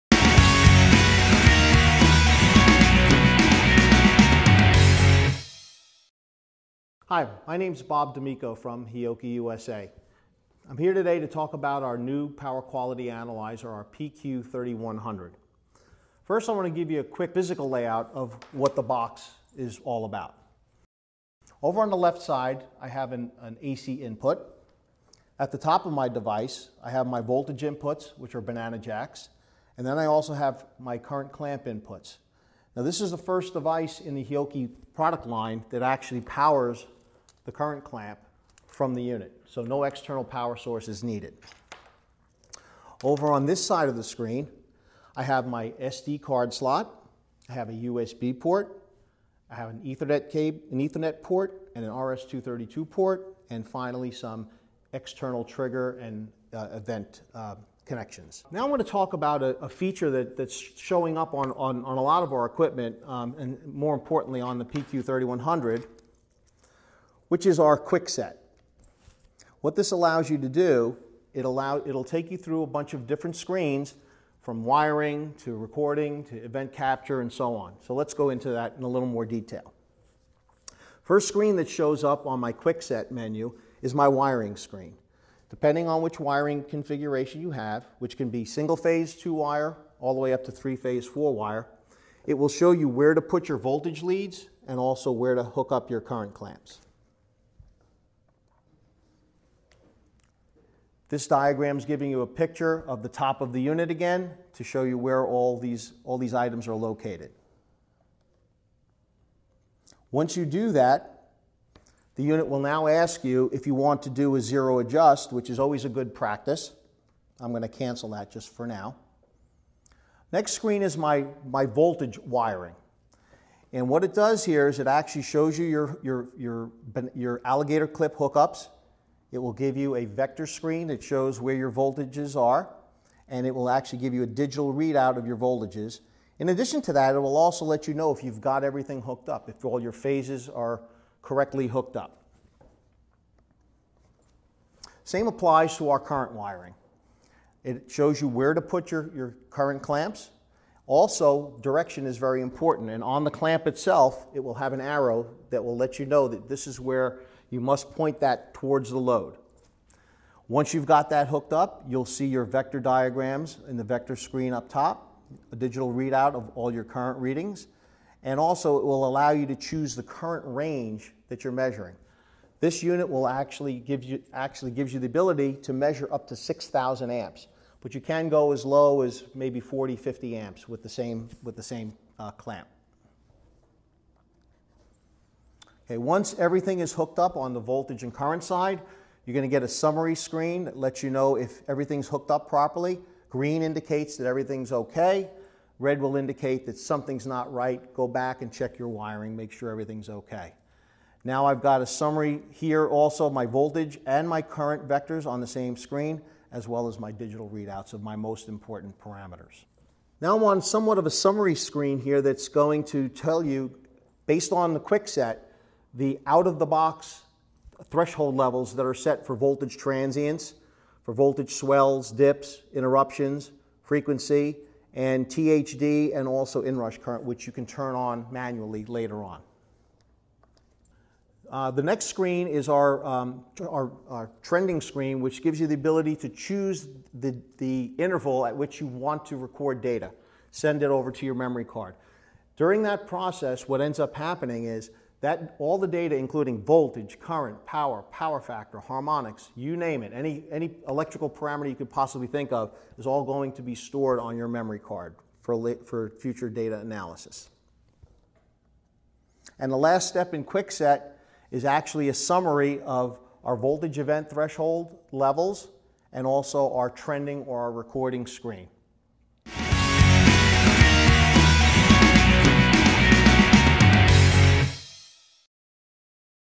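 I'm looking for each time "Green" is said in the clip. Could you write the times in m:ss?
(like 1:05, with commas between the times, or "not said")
3:13.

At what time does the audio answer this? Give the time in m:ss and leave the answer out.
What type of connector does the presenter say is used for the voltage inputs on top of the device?
0:28.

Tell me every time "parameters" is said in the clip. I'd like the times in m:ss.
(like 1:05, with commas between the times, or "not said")
3:28, 4:11.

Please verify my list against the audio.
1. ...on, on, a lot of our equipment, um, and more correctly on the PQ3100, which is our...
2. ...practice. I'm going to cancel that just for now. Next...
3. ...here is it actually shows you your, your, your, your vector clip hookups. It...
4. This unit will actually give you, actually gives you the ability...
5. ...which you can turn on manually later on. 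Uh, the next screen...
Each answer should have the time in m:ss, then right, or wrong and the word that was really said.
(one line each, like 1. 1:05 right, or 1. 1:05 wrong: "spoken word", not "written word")
1. 1:01 wrong: "importantly", not "correctly"
2. 1:56 right
3. 2:04 wrong: "alligator", not "vector"
4. 2:52 right
5. 3:47 right.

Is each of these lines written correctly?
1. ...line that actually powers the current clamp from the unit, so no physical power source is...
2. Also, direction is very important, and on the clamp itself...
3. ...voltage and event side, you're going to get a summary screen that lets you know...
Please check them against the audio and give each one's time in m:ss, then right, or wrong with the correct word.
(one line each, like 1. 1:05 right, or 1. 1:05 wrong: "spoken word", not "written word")
1. 0:35 wrong: "external", not "physical"
2. 2:30 right
3. 3:07 wrong: "current", not "event".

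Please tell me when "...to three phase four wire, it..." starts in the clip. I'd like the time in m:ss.
1:30.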